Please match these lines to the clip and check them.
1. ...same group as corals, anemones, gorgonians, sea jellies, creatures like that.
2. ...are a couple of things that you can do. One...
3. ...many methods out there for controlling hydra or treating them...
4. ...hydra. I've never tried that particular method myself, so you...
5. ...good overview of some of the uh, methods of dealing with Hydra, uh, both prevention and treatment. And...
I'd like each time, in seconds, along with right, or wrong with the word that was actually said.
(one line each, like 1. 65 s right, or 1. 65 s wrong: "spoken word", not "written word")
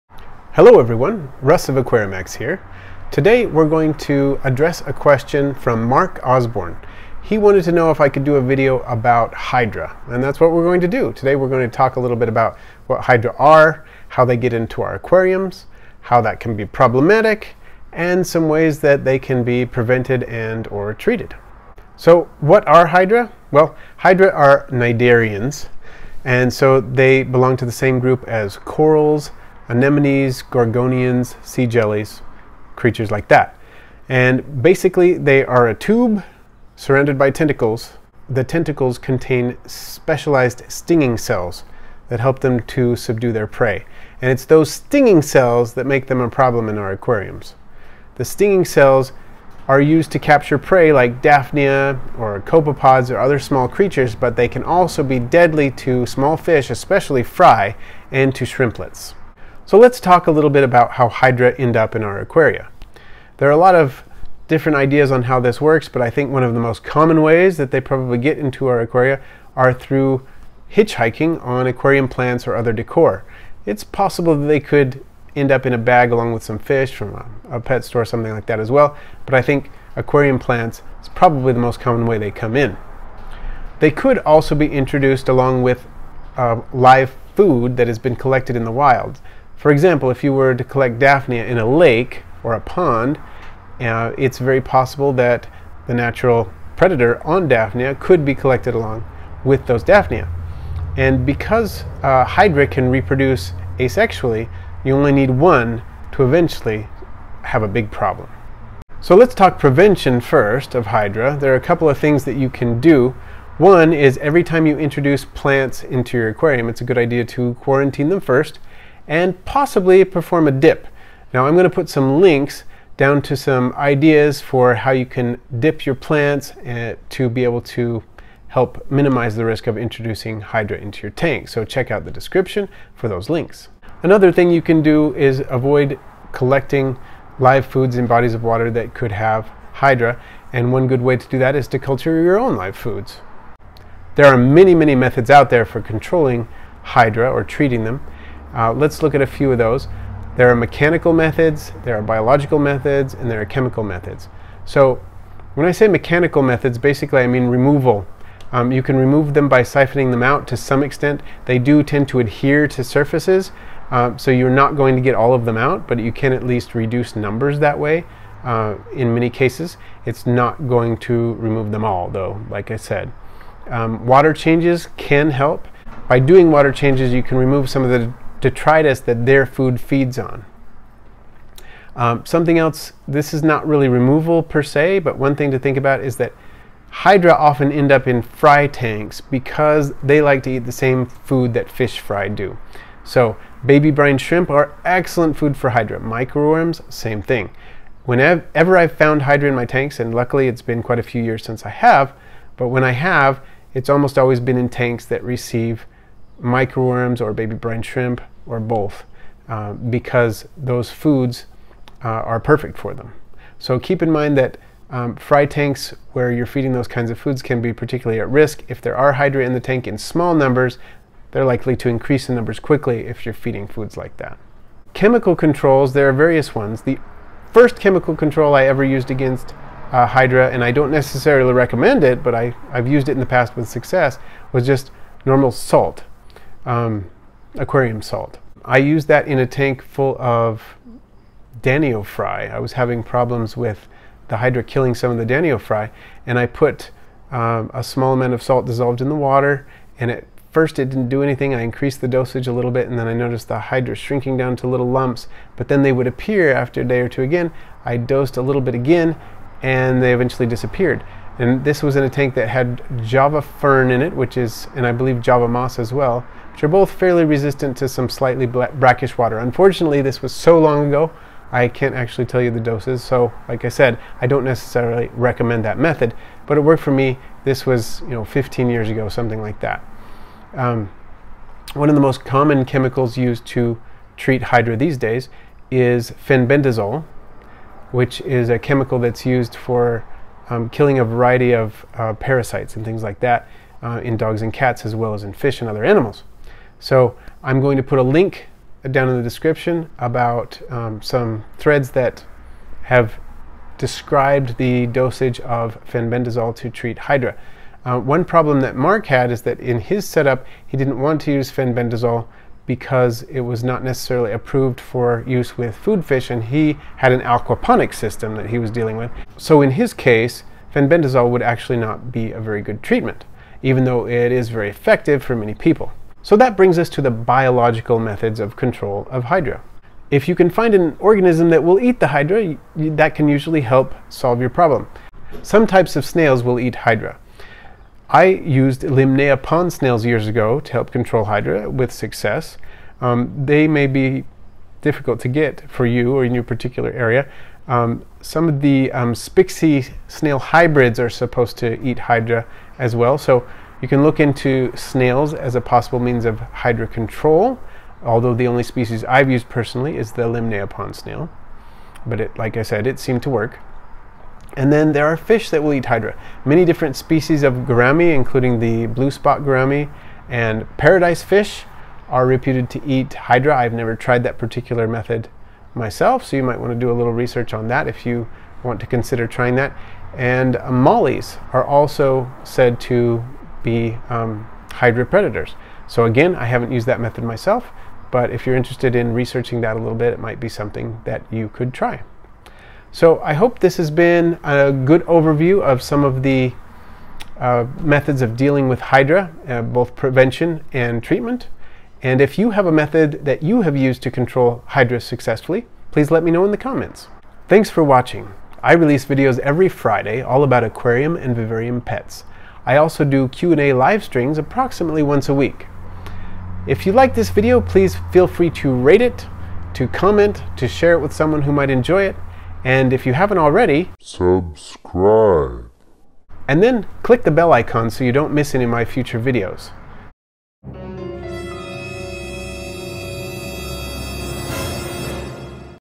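1. 27 s right
2. 111 s right
3. 144 s right
4. 373 s right
5. 394 s right.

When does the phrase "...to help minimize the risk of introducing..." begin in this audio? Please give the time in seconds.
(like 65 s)
127 s.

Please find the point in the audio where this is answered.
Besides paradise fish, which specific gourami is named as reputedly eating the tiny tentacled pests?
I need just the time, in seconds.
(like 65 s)
368 s.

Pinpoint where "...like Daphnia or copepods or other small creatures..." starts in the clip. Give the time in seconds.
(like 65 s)
50 s.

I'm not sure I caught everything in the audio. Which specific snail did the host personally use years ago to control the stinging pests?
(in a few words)
Lymnaea pond snails.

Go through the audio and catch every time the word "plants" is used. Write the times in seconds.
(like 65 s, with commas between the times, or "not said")
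72 s, 80 s, 115 s, 125 s.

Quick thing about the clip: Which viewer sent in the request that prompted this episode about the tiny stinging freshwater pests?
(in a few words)
Mark Osborne.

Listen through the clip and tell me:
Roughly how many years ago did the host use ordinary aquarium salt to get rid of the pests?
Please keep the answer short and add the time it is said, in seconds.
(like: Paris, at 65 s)
15, at 278 s.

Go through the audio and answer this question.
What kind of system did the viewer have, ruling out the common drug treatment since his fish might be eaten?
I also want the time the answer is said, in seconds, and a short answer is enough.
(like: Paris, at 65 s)
aquaponic system, at 317 s.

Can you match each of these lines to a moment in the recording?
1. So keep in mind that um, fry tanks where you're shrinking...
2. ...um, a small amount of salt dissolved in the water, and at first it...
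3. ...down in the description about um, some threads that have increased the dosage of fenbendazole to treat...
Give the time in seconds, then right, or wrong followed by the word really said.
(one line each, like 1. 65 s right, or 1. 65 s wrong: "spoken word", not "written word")
1. 213 s wrong: "feeding", not "shrinking"
2. 247 s right
3. 298 s wrong: "described", not "increased".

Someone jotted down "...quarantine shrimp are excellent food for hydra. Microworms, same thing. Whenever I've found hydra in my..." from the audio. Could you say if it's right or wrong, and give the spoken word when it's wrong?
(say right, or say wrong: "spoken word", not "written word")
wrong: "brine", not "quarantine".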